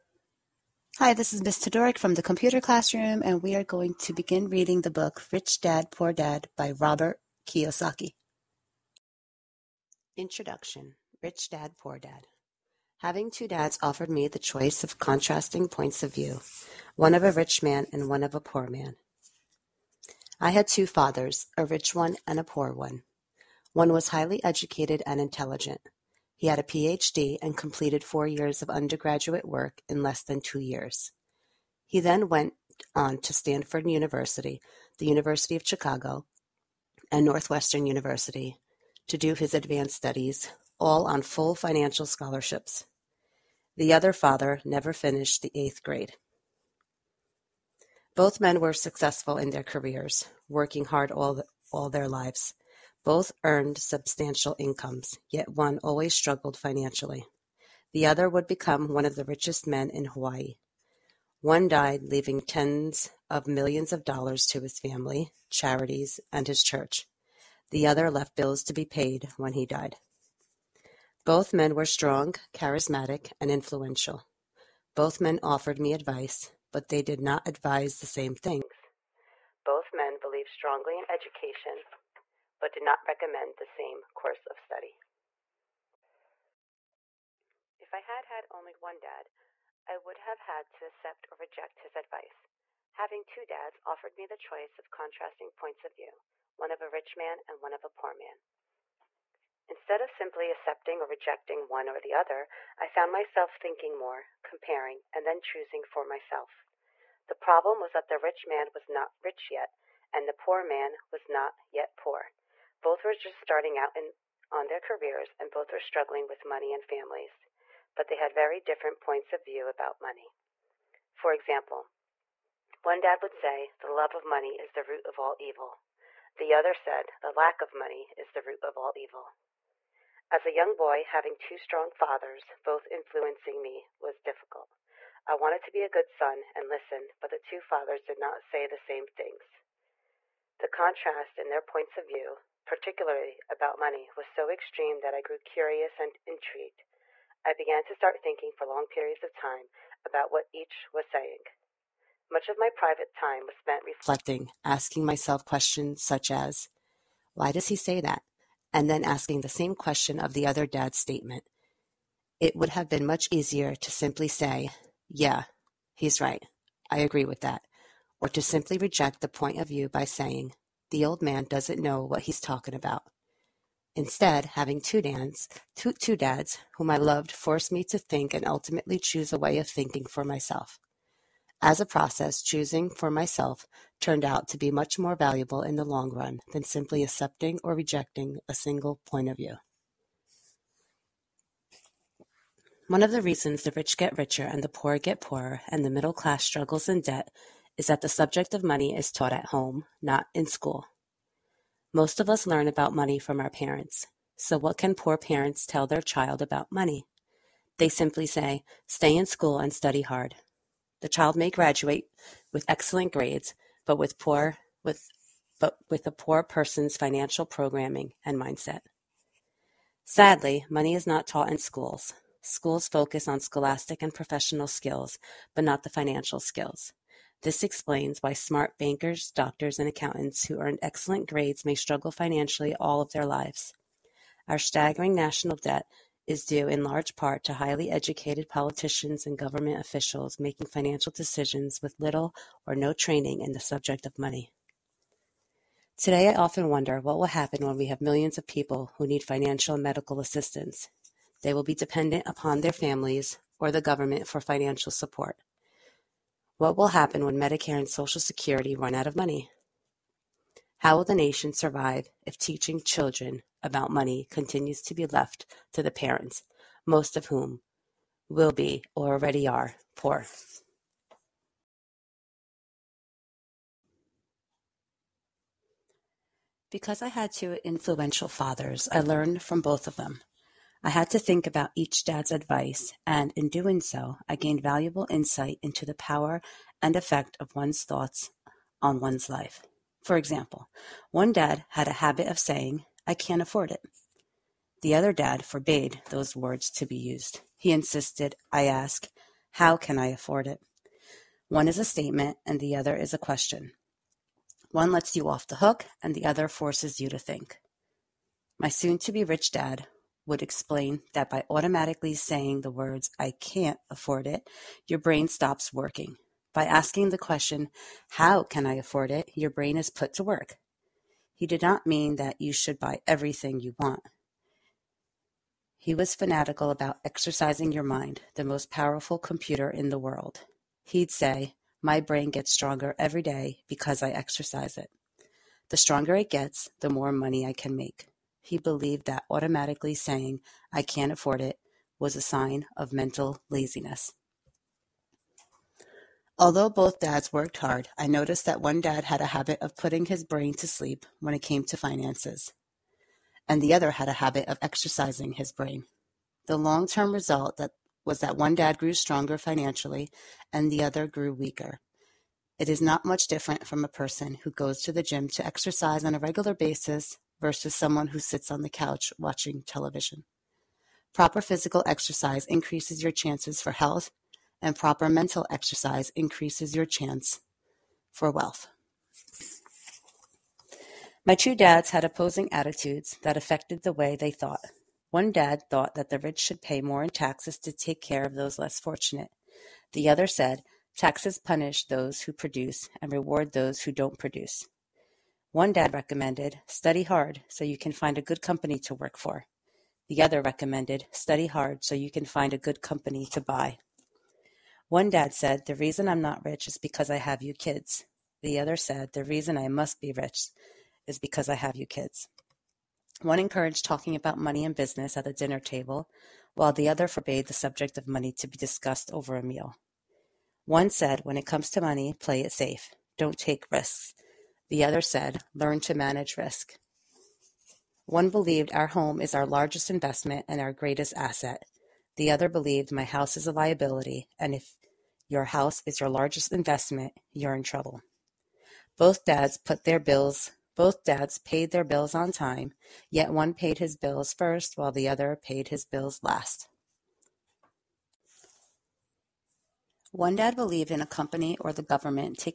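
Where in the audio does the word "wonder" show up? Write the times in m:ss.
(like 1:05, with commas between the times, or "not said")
4:06.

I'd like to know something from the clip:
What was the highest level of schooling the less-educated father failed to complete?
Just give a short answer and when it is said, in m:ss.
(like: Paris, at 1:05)
8th grade, at 0:45.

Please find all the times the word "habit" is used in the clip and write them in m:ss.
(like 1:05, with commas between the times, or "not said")
4:51, 5:49, 5:54.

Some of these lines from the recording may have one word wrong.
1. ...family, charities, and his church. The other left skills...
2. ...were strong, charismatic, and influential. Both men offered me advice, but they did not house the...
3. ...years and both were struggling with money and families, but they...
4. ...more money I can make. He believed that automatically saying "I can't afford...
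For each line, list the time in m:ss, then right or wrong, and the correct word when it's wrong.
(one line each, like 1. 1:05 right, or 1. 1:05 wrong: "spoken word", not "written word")
1. 1:04 wrong: "bills", not "skills"
2. 1:11 wrong: "advise", not "house"
3. 1:54 wrong: "careers", not "years"
4. 5:36 right.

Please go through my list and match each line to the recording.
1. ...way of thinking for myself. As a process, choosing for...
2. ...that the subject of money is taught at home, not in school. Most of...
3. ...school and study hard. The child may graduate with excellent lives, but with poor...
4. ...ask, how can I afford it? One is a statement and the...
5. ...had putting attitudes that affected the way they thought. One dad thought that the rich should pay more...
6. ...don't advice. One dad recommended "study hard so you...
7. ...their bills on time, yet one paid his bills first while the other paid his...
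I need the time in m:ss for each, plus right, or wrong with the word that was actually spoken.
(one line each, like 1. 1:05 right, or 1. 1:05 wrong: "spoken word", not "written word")
1. 2:59 right
2. 3:17 right
3. 3:29 wrong: "grades", not "lives"
4. 4:58 right
5. 6:21 wrong: "opposing", not "putting"
6. 6:33 wrong: "produce", not "advice"
7. 7:21 right.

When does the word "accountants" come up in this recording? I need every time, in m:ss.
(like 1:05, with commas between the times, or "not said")
3:49.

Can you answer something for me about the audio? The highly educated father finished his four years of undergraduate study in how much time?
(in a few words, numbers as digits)
less than 2 years.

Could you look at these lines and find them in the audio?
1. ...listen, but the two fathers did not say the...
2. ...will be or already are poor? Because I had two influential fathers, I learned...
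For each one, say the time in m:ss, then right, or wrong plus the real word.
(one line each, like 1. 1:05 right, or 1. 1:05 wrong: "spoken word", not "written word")
1. 2:16 right
2. 4:28 right.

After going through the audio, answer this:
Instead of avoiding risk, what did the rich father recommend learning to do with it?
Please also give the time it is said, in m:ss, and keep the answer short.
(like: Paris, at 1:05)
manage risk, at 7:05.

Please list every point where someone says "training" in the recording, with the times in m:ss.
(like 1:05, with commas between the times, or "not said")
4:02.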